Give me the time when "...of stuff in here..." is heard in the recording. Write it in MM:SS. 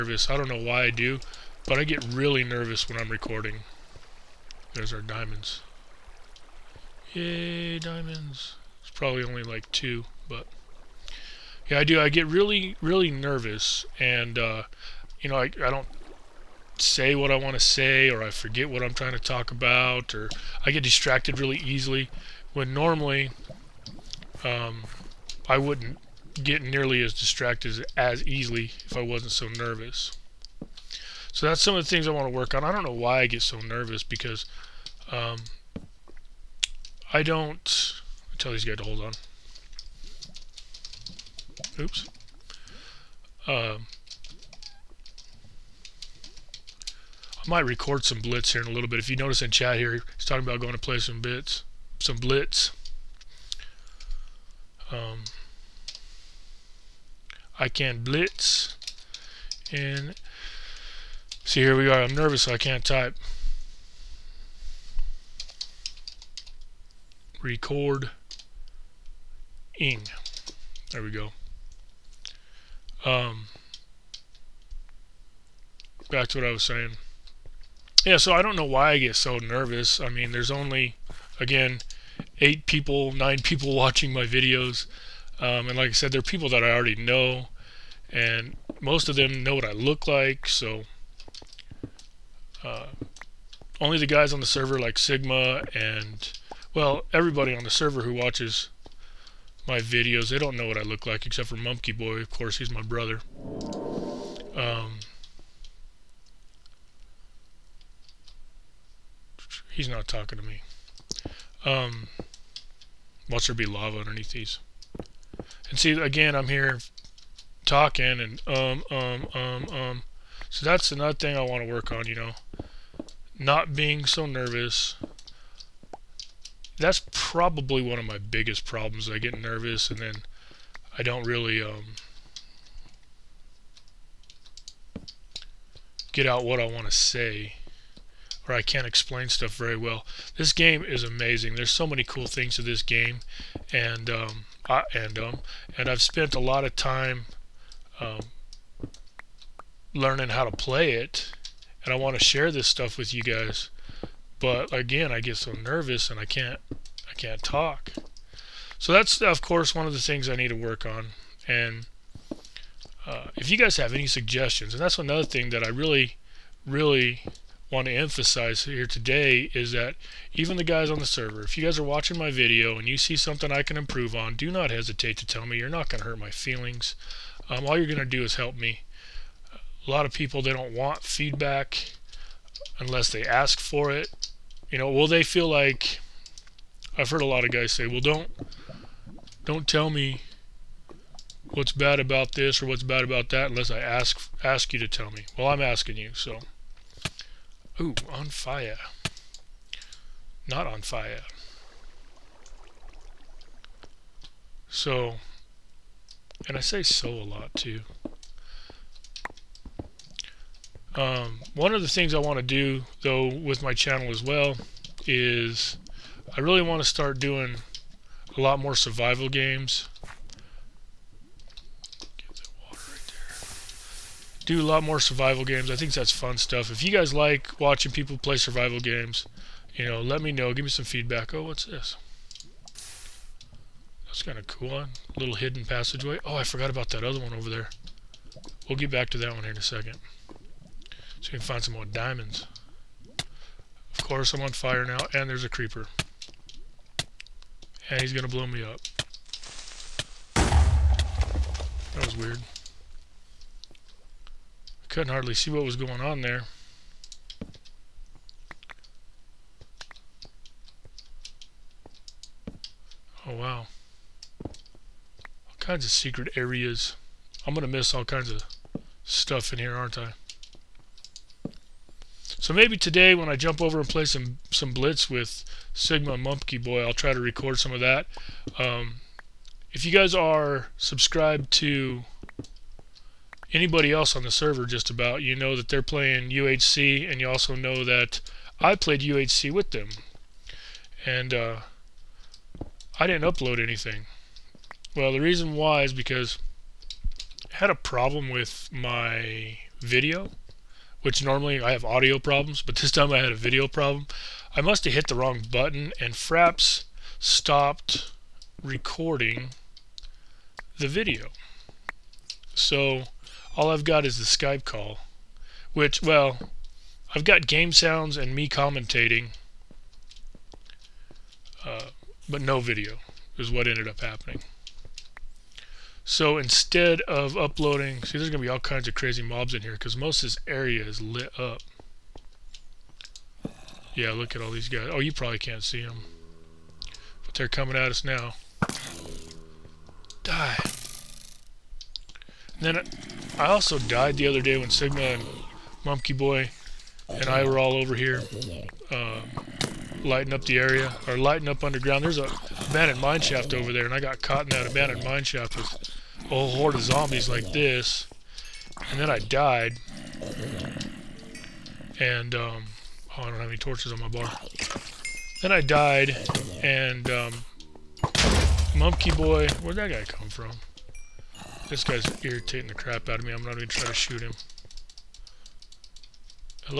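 04:28.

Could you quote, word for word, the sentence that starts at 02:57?
Um, all you're going to do is help me.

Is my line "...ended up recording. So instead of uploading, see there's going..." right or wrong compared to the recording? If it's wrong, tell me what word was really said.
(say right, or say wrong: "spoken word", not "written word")
wrong: "happening", not "recording".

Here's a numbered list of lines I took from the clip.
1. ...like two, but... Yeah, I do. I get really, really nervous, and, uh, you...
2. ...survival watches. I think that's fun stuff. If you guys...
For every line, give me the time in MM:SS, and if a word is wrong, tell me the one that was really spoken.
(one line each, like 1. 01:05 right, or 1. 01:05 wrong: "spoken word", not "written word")
1. 00:09 right
2. 03:45 wrong: "games", not "watches".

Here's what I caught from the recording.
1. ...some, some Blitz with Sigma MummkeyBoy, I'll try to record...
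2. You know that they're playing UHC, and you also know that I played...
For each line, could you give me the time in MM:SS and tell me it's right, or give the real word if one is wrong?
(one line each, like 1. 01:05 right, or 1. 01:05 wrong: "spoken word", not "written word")
1. 04:34 right
2. 04:45 right.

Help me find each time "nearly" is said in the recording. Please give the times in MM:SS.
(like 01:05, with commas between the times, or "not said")
00:26.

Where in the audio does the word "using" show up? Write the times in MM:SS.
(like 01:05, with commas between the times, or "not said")
not said.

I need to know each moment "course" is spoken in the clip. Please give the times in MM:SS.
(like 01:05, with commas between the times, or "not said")
01:42, 02:39, 04:04.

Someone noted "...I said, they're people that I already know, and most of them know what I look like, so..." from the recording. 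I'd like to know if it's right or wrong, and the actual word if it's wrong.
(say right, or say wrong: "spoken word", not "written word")
right.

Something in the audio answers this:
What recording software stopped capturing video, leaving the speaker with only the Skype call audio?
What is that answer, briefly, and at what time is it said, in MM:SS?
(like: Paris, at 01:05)
Fraps, at 05:06.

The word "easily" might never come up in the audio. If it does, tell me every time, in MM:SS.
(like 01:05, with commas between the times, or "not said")
00:21, 00:28.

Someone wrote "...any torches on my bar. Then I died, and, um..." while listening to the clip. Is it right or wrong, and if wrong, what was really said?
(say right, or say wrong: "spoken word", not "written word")
right.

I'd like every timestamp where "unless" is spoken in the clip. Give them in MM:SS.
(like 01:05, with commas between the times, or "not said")
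03:02, 03:13.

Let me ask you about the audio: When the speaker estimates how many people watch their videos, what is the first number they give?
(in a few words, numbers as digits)
8.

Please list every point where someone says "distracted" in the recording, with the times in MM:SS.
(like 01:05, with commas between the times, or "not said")
00:20, 00:27.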